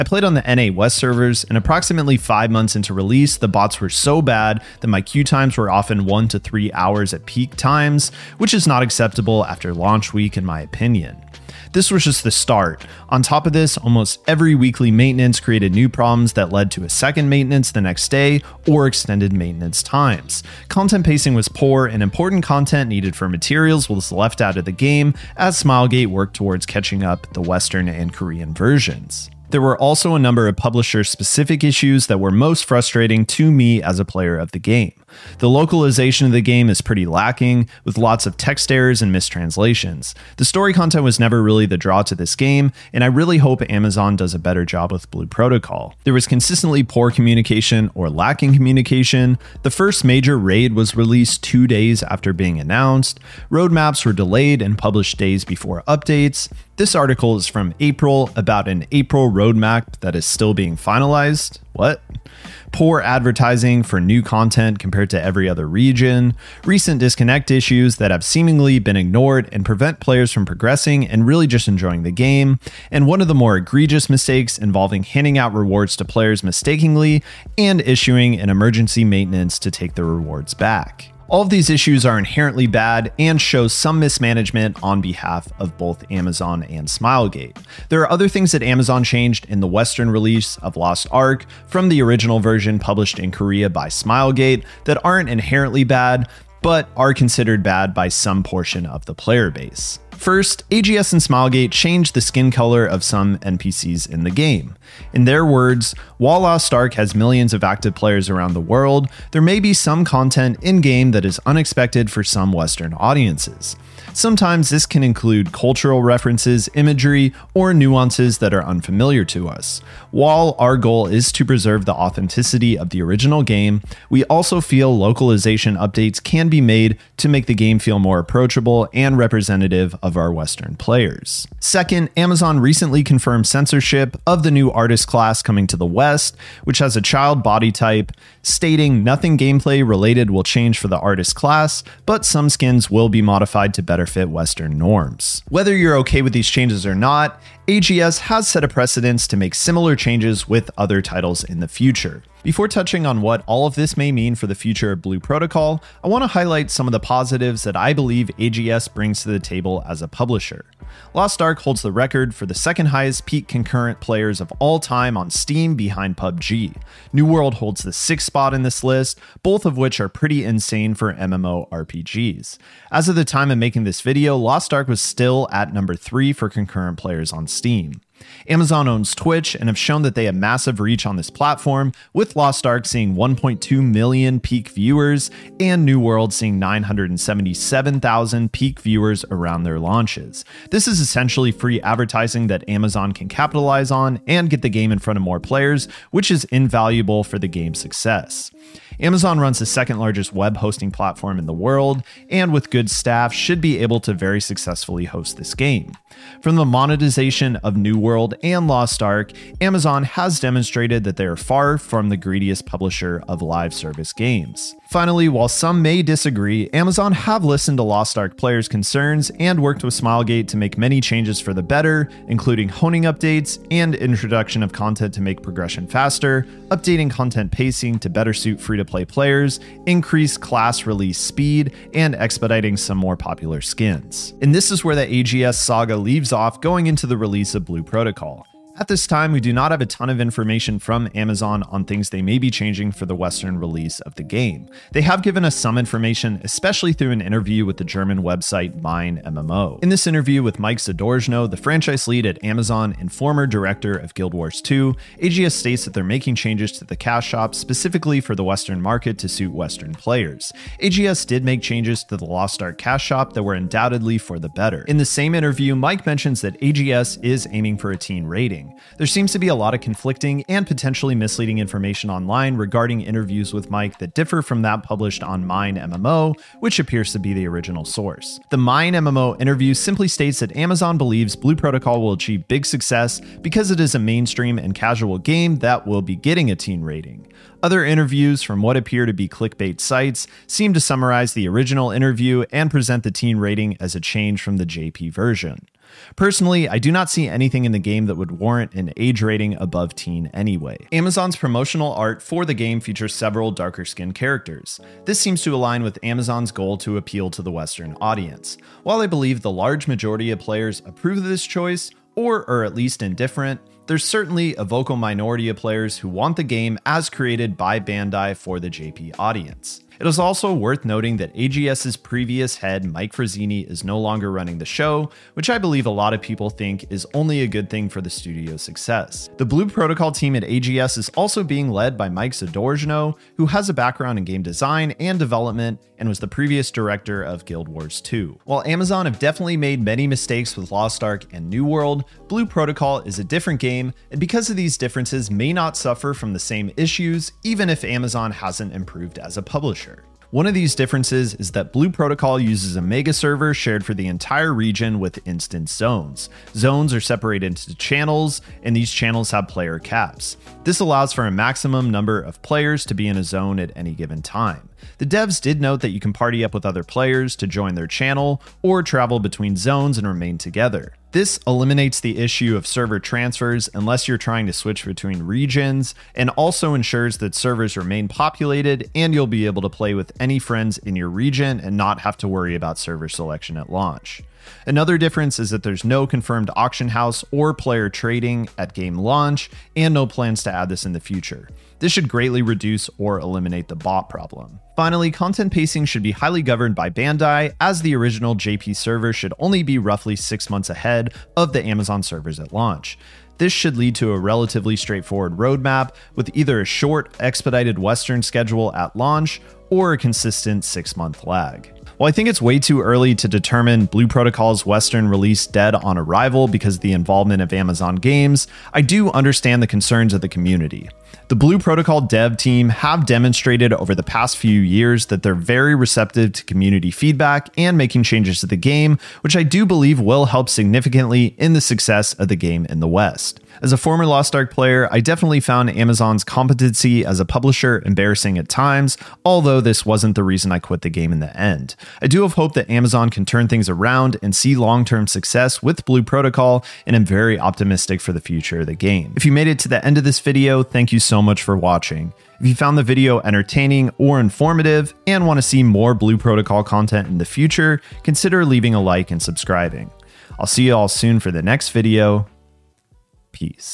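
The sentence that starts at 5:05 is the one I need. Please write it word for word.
This seems to align with Amazon's goal to appeal to the Western audience.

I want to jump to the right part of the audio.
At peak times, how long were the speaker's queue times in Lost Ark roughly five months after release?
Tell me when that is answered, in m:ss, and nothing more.
0:06.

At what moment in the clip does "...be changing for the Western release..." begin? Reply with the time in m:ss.
4:02.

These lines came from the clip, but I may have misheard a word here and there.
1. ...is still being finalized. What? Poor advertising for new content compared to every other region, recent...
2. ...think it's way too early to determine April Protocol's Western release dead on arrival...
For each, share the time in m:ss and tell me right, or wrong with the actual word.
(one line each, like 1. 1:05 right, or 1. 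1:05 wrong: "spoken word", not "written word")
1. 1:00 right
2. 6:52 wrong: "Blue", not "April".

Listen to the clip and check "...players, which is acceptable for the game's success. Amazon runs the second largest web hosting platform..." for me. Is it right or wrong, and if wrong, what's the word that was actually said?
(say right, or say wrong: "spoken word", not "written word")
wrong: "invaluable", not "acceptable".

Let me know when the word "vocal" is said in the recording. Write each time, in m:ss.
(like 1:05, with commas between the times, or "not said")
5:14.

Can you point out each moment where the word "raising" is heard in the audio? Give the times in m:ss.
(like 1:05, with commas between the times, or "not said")
not said.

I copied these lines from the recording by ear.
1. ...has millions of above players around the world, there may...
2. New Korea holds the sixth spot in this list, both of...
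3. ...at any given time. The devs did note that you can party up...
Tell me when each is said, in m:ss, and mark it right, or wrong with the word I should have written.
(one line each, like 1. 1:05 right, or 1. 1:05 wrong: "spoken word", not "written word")
1. 1:46 wrong: "active", not "above"
2. 2:47 wrong: "World", not "Korea"
3. 6:03 right.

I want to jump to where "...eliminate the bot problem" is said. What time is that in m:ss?
6:33.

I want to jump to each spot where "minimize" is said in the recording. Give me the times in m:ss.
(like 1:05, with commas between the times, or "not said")
not said.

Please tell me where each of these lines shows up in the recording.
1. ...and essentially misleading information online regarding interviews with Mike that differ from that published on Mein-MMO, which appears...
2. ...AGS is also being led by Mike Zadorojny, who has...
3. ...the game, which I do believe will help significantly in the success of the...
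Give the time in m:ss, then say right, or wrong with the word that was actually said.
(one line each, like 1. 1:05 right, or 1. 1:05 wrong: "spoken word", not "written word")
1. 4:30 wrong: "potentially", not "essentially"
2. 5:30 right
3. 7:08 right.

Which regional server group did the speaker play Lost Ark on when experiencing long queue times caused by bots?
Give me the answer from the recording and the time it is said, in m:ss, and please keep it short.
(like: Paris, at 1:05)
NA West, at 0:00.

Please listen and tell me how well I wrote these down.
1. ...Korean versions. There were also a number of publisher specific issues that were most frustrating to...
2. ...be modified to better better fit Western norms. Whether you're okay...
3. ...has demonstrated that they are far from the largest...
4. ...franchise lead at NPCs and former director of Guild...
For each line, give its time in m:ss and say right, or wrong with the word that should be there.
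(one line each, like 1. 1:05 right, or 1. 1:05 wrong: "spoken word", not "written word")
1. 0:28 right
2. 2:23 right
3. 3:30 wrong: "greediest", not "largest"
4. 4:11 wrong: "Amazon", not "NPCs".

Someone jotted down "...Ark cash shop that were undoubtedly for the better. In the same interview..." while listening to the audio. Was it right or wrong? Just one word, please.
right.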